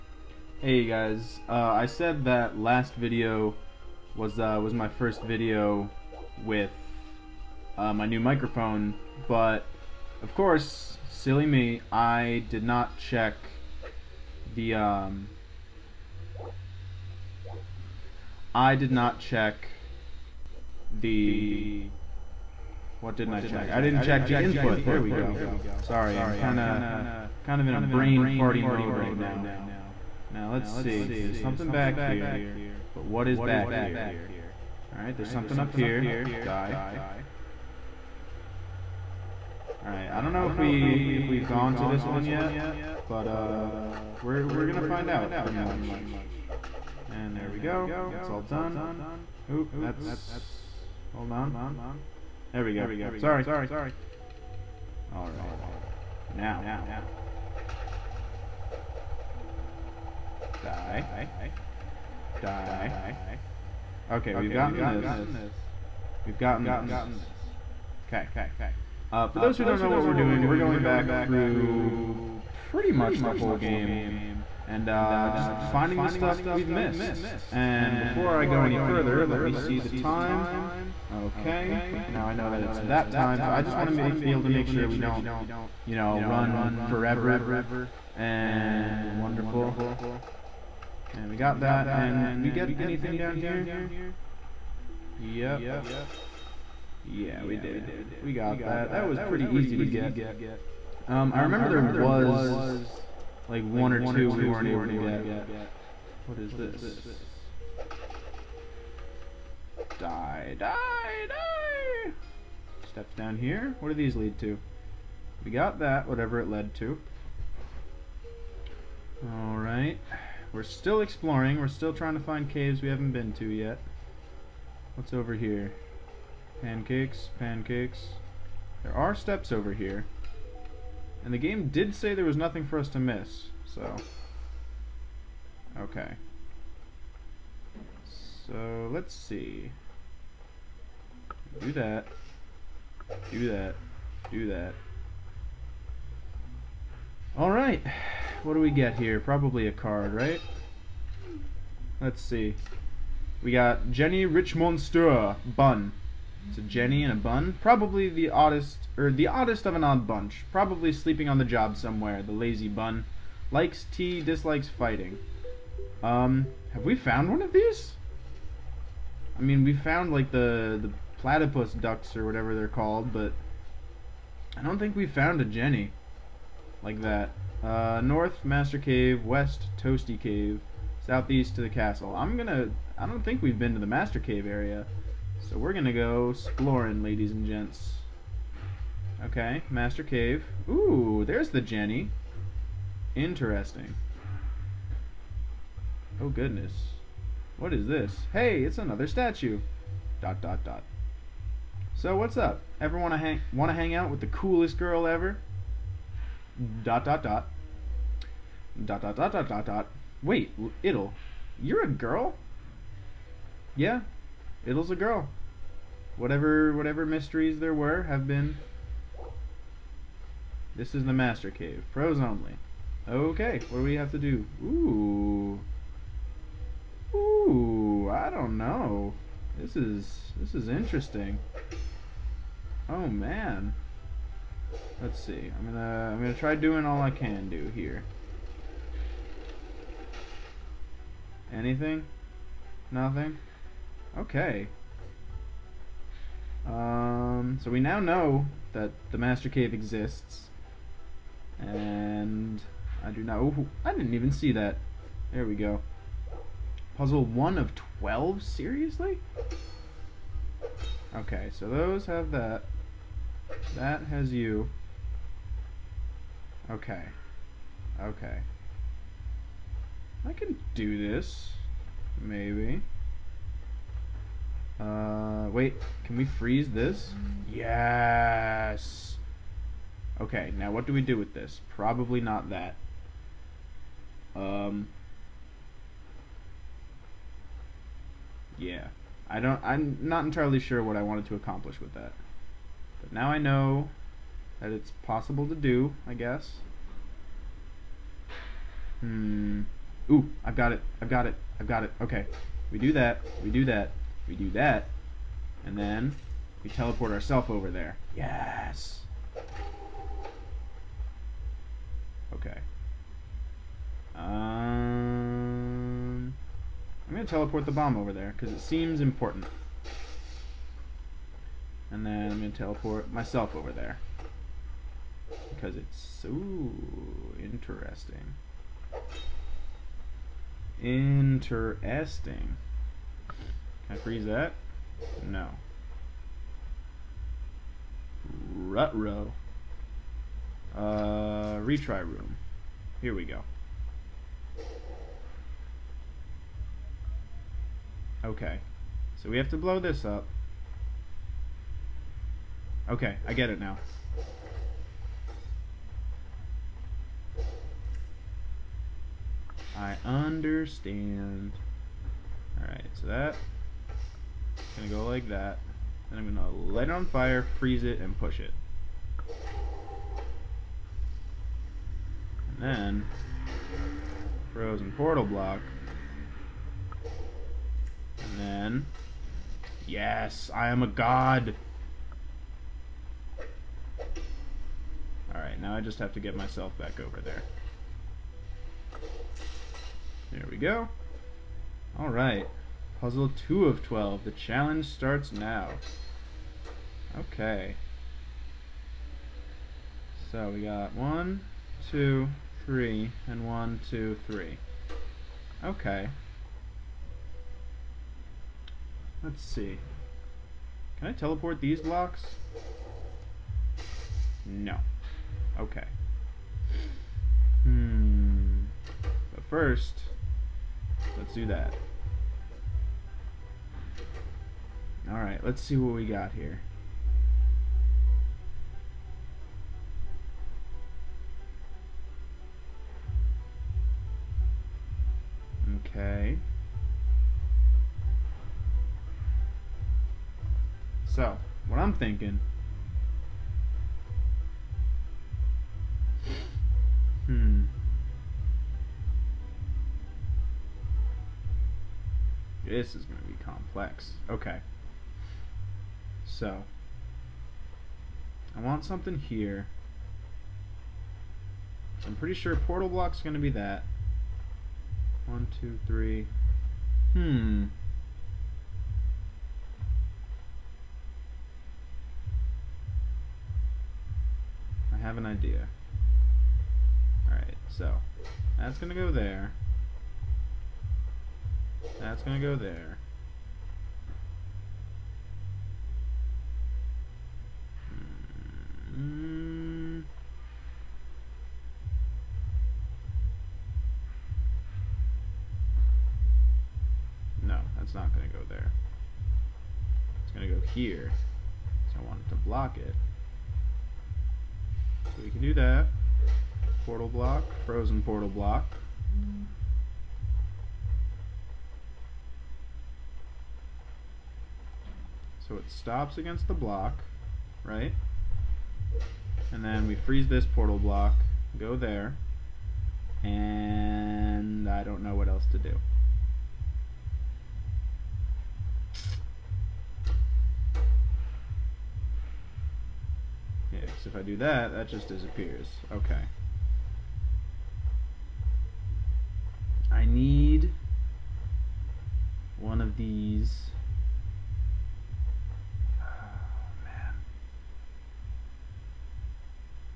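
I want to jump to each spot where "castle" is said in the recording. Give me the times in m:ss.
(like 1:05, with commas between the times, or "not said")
3:01.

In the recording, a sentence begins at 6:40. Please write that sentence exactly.
So we got one, two, three, and one, two, three.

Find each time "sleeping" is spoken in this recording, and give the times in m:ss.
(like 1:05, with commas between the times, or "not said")
2:40.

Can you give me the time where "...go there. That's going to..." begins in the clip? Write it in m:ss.
7:58.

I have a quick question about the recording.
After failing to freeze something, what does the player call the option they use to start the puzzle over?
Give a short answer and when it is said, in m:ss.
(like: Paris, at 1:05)
retry room, at 5:41.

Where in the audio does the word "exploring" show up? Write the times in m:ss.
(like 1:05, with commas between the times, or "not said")
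2:01, 3:06.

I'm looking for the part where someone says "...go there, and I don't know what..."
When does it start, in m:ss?
8:41.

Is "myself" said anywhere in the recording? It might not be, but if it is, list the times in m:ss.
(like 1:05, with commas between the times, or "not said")
5:23, 6:26.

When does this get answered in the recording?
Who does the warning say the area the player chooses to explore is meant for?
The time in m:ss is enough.
3:41.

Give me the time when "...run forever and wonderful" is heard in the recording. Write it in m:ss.
1:26.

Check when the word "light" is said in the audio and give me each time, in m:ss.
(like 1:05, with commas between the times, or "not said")
6:06.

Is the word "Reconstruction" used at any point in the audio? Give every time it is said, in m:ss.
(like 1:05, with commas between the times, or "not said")
not said.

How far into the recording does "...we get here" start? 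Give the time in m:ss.
2:28.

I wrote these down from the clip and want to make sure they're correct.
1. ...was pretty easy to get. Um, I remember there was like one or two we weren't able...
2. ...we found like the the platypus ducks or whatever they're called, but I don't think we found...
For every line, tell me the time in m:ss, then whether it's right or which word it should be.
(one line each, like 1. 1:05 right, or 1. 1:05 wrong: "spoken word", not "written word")
1. 1:39 right
2. 2:49 right.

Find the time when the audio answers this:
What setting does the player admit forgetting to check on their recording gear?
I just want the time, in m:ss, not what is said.
0:24.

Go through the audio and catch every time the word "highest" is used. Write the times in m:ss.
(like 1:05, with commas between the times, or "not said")
not said.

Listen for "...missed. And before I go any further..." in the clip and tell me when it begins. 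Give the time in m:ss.
1:16.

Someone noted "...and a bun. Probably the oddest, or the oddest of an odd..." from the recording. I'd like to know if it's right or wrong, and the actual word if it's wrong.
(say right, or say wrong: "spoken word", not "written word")
right.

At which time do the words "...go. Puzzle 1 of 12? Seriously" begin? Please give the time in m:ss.
4:15.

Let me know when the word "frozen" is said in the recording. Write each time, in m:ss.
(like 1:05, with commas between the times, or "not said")
6:14, 8:27.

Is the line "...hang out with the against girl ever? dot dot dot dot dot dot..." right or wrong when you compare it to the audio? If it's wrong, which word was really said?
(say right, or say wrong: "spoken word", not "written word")
wrong: "coolest", not "against".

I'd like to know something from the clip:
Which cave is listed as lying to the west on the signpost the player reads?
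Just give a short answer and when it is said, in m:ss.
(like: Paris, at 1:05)
Toasty Cave, at 2:59.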